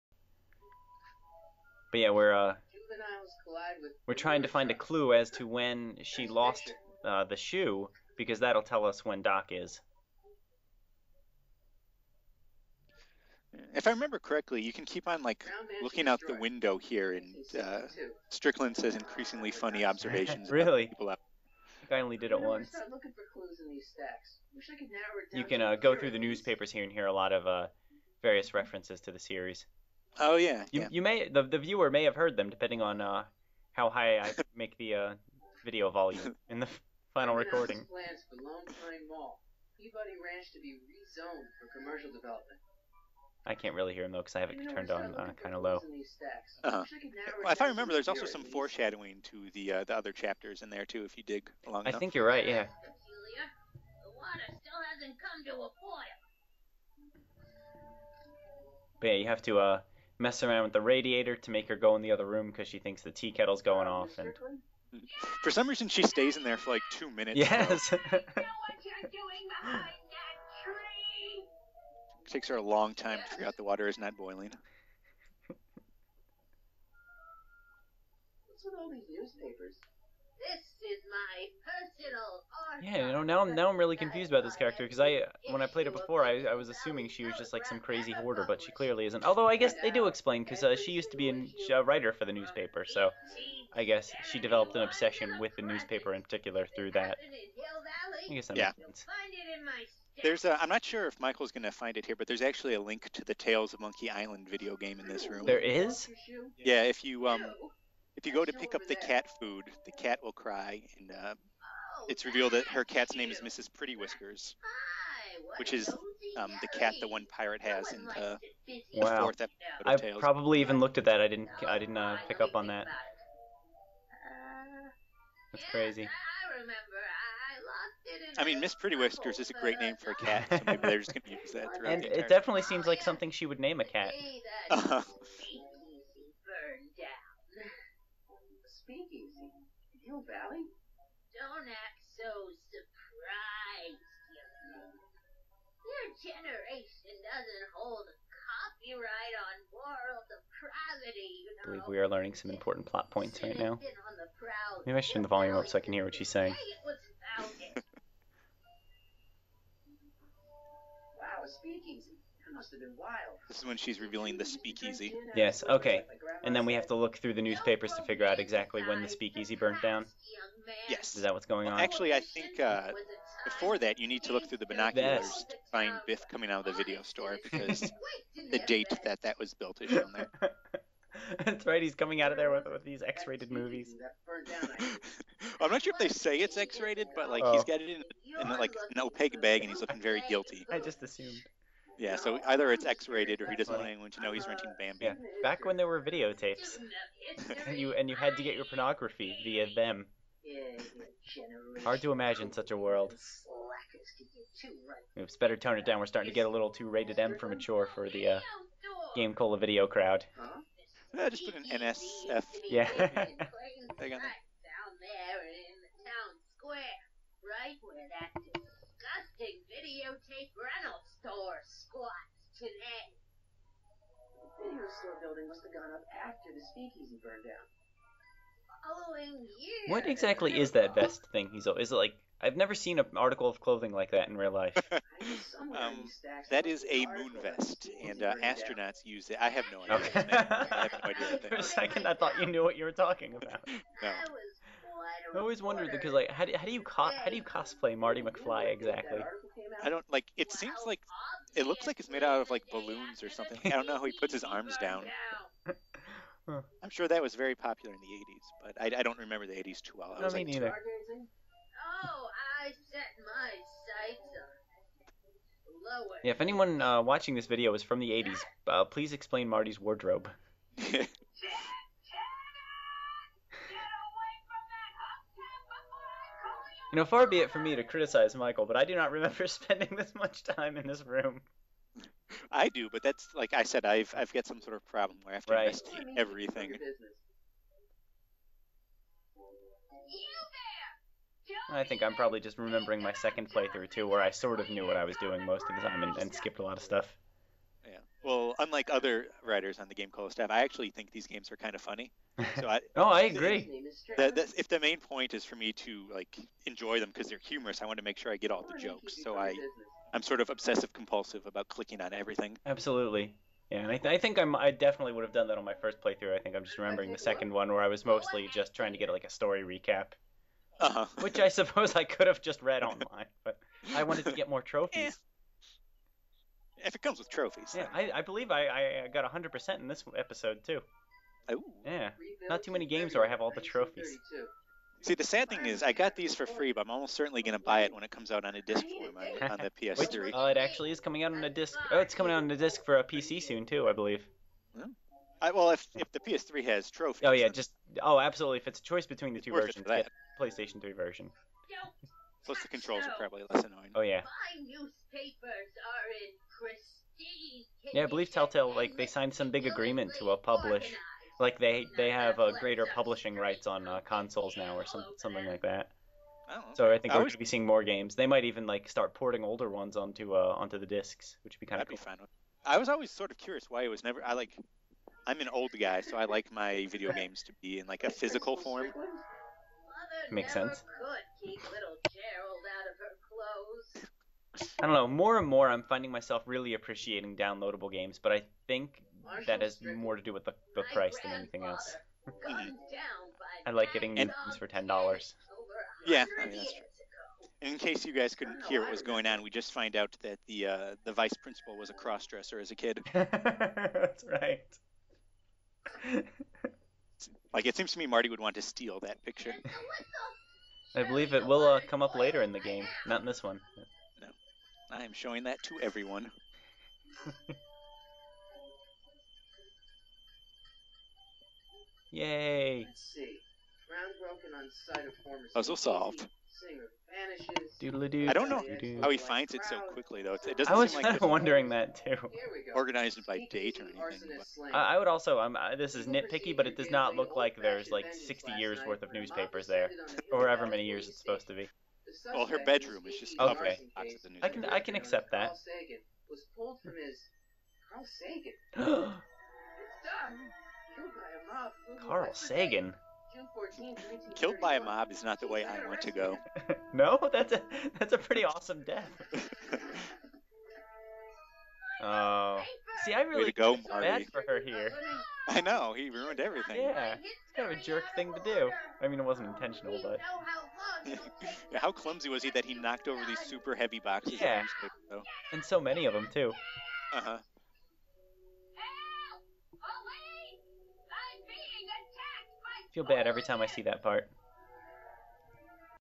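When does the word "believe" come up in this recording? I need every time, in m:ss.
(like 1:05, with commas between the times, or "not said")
2:31, 5:28, 5:43, 5:58, 6:51.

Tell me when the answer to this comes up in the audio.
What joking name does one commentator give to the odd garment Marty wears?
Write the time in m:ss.
3:57.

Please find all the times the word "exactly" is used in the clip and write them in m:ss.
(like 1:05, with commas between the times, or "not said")
2:48, 3:50, 4:08.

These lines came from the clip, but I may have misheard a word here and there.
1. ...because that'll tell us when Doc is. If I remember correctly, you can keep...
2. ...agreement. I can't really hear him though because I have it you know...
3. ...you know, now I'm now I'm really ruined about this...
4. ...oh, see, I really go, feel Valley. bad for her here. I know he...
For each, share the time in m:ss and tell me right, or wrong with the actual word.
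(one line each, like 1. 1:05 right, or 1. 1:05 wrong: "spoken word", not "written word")
1. 0:08 right
2. 0:42 wrong: "development", not "agreement"
3. 1:23 wrong: "confused", not "ruined"
4. 7:42 wrong: "Marty", not "Valley".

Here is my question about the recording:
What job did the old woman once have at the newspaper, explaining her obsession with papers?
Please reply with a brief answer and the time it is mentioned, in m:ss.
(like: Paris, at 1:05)
writer, at 1:31.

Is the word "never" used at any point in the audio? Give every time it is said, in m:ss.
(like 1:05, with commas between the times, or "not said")
3:52, 6:14.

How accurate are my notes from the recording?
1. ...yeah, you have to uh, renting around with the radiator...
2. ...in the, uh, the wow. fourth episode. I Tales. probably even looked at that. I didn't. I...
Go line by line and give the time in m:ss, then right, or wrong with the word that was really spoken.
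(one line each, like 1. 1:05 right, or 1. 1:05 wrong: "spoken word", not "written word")
1. 0:59 wrong: "messing", not "renting"
2. 1:57 right.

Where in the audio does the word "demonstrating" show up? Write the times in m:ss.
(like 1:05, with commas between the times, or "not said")
not said.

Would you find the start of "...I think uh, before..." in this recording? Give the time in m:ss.
2:52.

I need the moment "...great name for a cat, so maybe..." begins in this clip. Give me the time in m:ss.
2:09.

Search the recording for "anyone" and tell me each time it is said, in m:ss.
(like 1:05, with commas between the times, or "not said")
3:13, 4:26.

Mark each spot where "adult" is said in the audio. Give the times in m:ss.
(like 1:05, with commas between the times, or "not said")
not said.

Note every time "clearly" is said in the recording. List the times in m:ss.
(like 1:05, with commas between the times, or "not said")
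1:28.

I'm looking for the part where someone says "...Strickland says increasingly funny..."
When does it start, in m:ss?
0:18.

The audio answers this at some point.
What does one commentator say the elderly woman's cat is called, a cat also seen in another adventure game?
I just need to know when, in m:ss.
1:53.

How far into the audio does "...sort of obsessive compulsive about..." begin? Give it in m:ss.
5:10.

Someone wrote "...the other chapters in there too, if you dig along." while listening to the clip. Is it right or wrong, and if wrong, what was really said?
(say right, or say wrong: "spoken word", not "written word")
right.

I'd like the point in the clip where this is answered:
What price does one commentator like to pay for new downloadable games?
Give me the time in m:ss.
6:34.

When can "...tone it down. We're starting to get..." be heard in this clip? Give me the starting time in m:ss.
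3:25.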